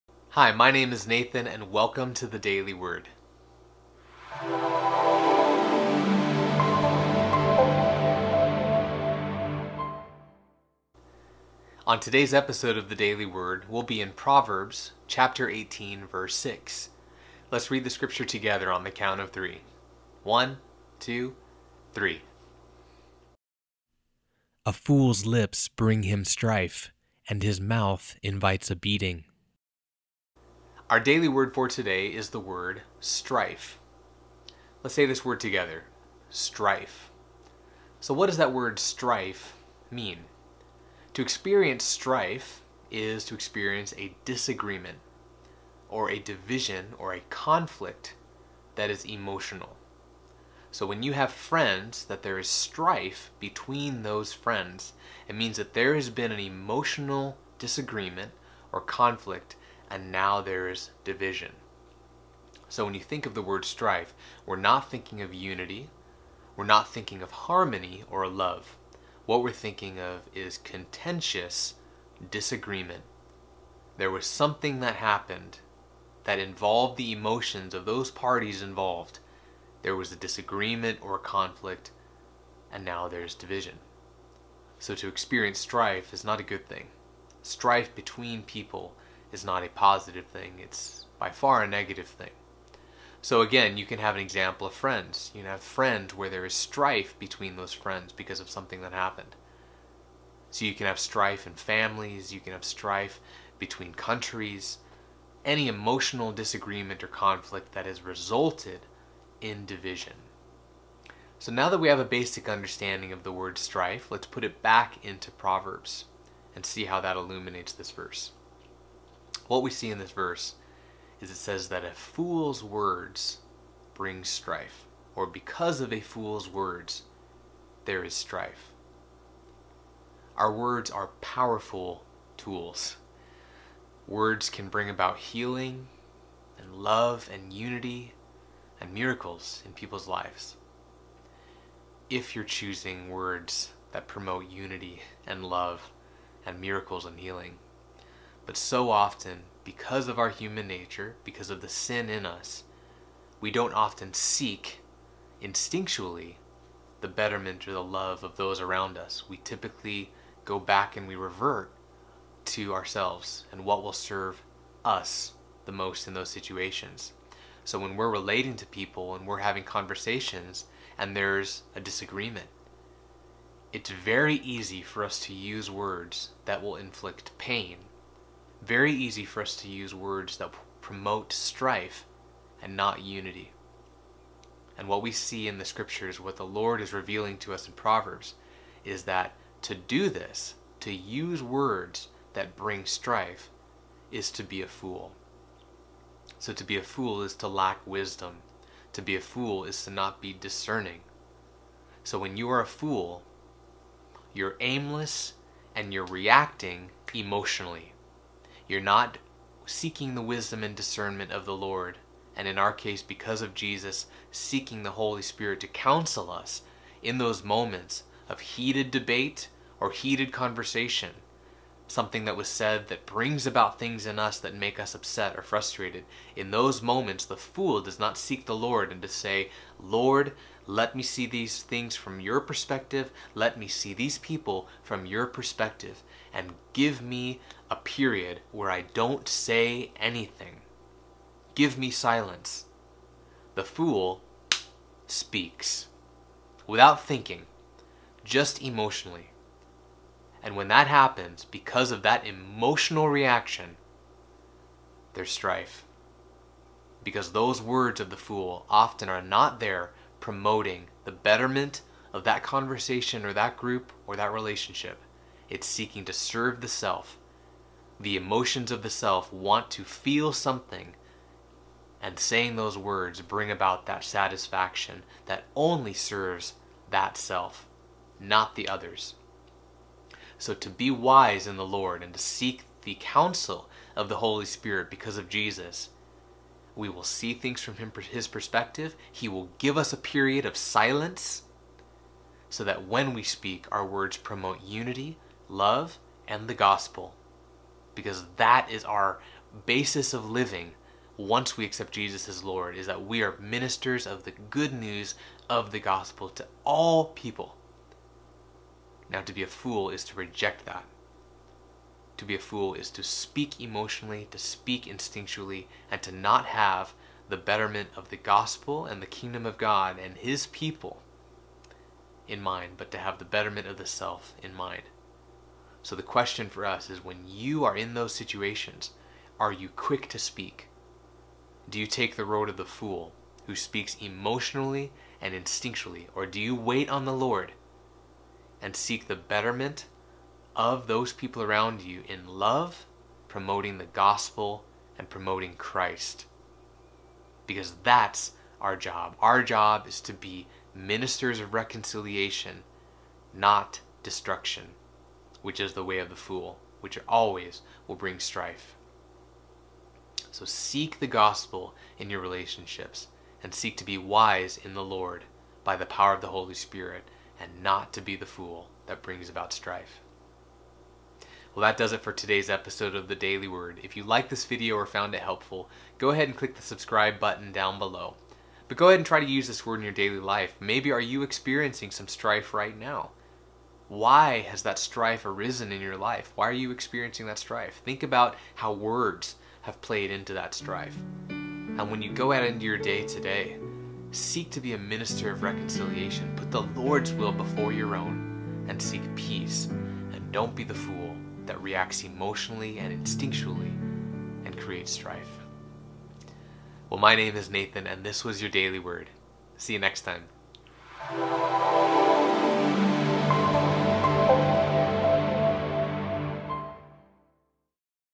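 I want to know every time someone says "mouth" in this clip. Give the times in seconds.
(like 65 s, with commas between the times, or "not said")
27 s.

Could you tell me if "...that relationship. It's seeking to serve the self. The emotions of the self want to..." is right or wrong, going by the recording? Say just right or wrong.
right.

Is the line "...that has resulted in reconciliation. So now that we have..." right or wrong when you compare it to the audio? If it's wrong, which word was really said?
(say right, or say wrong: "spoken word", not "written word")
wrong: "division", not "reconciliation".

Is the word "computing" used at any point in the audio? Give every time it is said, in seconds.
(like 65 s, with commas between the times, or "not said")
not said.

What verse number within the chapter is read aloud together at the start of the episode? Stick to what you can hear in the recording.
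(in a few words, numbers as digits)
6.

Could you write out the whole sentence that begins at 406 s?
Well, my name is Nathan, and this was your daily word.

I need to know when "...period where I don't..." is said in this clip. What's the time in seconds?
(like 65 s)
237 s.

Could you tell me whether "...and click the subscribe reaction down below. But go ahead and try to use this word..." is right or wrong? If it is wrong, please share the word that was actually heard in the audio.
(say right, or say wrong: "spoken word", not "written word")
wrong: "button", not "reaction".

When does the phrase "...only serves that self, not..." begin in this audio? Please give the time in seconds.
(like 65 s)
275 s.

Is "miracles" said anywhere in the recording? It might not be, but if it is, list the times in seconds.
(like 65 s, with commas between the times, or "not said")
138 s, 146 s.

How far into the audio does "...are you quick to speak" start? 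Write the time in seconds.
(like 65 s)
329 s.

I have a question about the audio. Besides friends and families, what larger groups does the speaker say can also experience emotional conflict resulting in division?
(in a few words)
countries.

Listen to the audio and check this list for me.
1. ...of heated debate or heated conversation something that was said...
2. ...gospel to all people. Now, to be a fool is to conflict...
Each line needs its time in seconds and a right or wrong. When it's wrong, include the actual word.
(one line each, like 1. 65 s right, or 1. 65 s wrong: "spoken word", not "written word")
1. 218 s right
2. 305 s wrong: "reject", not "conflict".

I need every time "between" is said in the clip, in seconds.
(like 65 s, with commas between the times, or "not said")
53 s, 87 s, 97 s, 103 s.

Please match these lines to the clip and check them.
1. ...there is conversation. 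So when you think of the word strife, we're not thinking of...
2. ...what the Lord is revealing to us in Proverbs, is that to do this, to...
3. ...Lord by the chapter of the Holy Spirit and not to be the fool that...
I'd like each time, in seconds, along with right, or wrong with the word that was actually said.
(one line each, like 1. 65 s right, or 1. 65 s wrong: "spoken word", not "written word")
1. 60 s wrong: "division", not "conversation"
2. 186 s right
3. 364 s wrong: "power", not "chapter".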